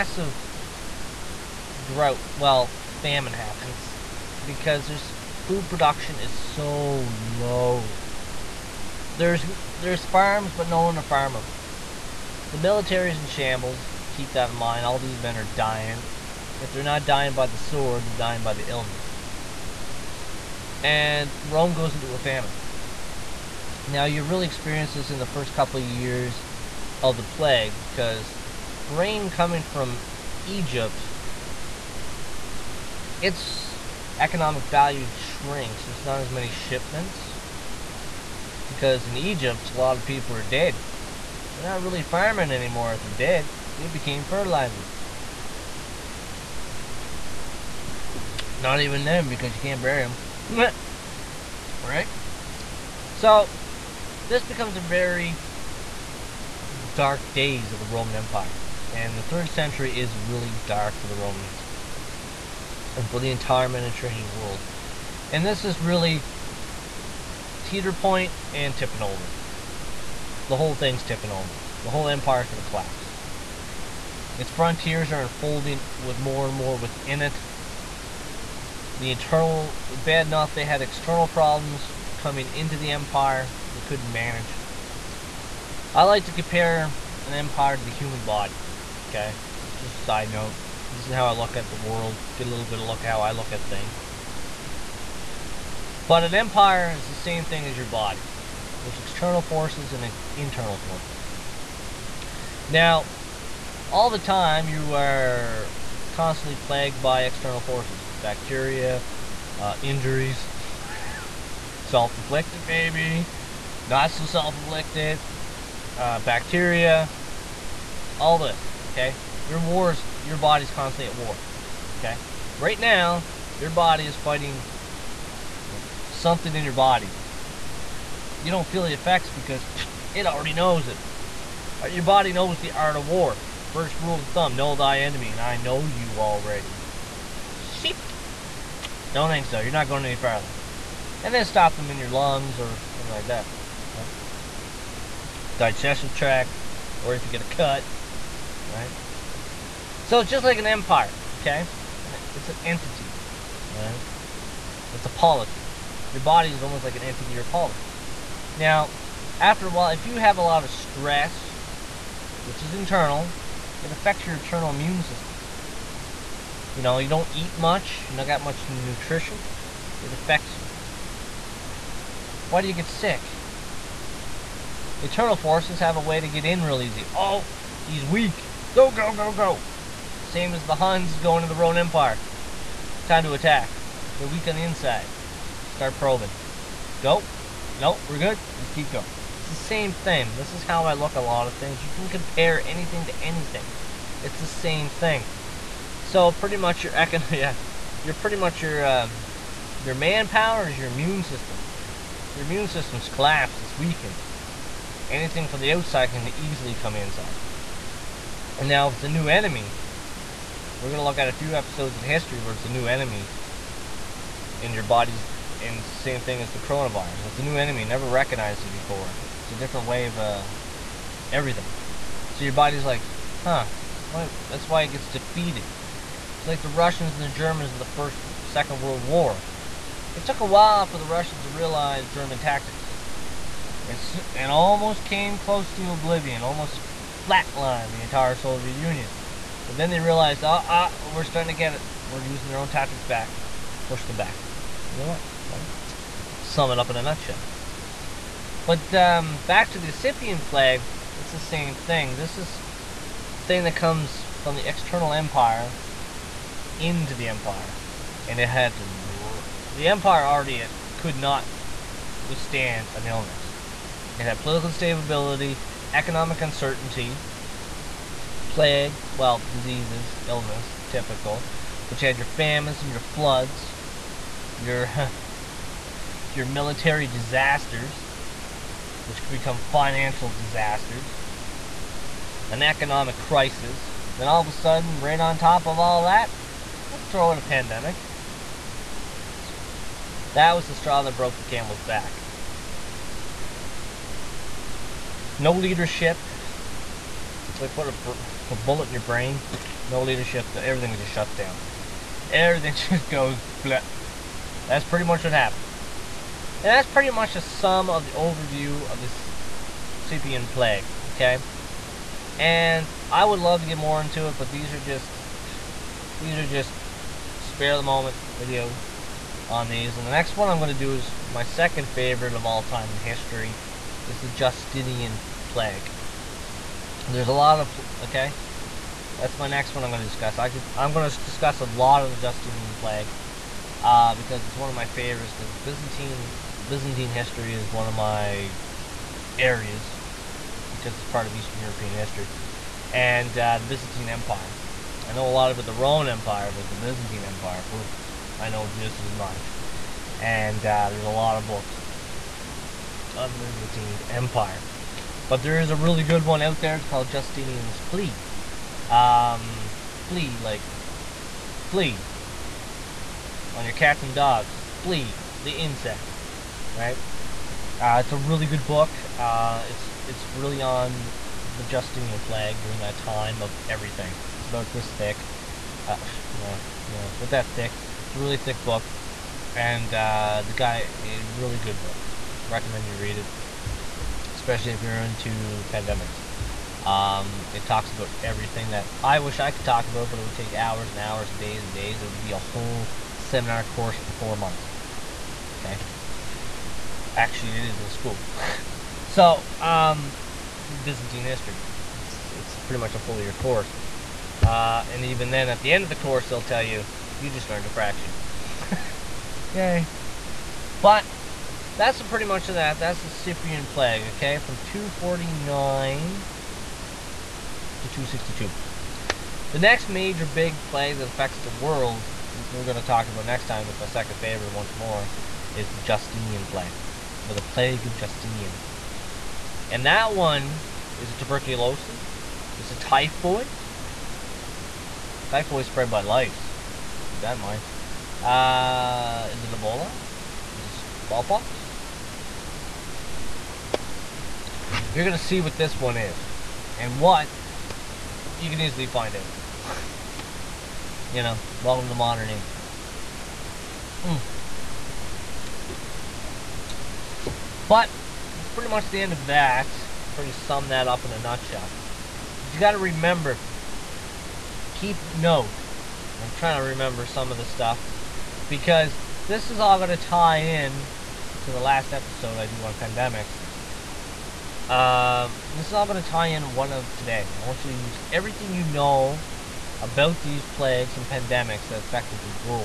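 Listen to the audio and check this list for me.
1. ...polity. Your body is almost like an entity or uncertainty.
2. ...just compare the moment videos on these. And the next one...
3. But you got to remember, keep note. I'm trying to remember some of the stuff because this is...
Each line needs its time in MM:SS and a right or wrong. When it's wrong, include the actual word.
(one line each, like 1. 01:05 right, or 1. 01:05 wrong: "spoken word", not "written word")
1. 02:35 wrong: "polity", not "uncertainty"
2. 05:16 wrong: "spare", not "compare"
3. 07:42 right.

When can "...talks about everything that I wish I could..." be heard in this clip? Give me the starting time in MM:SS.
06:27.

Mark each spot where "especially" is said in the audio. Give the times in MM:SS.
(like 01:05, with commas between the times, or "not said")
06:24.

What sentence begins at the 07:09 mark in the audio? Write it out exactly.
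And that one is a tuberculosis, is a typhoid.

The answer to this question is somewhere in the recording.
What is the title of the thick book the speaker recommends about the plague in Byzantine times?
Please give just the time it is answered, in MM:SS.
05:57.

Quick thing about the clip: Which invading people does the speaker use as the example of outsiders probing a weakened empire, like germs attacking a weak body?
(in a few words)
The Huns.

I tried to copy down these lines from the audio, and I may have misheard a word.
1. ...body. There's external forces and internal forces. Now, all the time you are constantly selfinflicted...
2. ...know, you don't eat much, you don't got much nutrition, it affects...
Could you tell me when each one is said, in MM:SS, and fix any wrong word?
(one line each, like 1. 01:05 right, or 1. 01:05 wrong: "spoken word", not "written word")
1. 01:37 wrong: "plagued", not "selfinflicted"
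2. 02:46 right.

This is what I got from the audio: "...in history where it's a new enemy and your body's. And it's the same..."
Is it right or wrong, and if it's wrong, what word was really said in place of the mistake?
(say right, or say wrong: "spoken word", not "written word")
right.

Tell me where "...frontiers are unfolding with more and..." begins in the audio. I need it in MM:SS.
01:14.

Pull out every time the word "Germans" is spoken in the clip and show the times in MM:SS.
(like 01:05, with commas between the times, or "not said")
03:47, 03:52.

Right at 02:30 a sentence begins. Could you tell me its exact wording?
So it's just like an empire, okay?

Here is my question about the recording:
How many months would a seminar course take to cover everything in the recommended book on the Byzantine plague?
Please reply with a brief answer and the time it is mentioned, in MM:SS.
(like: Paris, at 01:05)
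4, at 06:34.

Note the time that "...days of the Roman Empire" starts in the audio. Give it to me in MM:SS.
00:57.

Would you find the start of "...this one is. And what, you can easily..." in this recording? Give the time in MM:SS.
07:25.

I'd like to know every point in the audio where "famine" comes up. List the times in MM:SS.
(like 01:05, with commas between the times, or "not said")
00:03, 00:22, 04:32.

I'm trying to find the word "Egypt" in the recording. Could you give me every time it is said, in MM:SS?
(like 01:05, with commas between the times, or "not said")
00:30, 00:39.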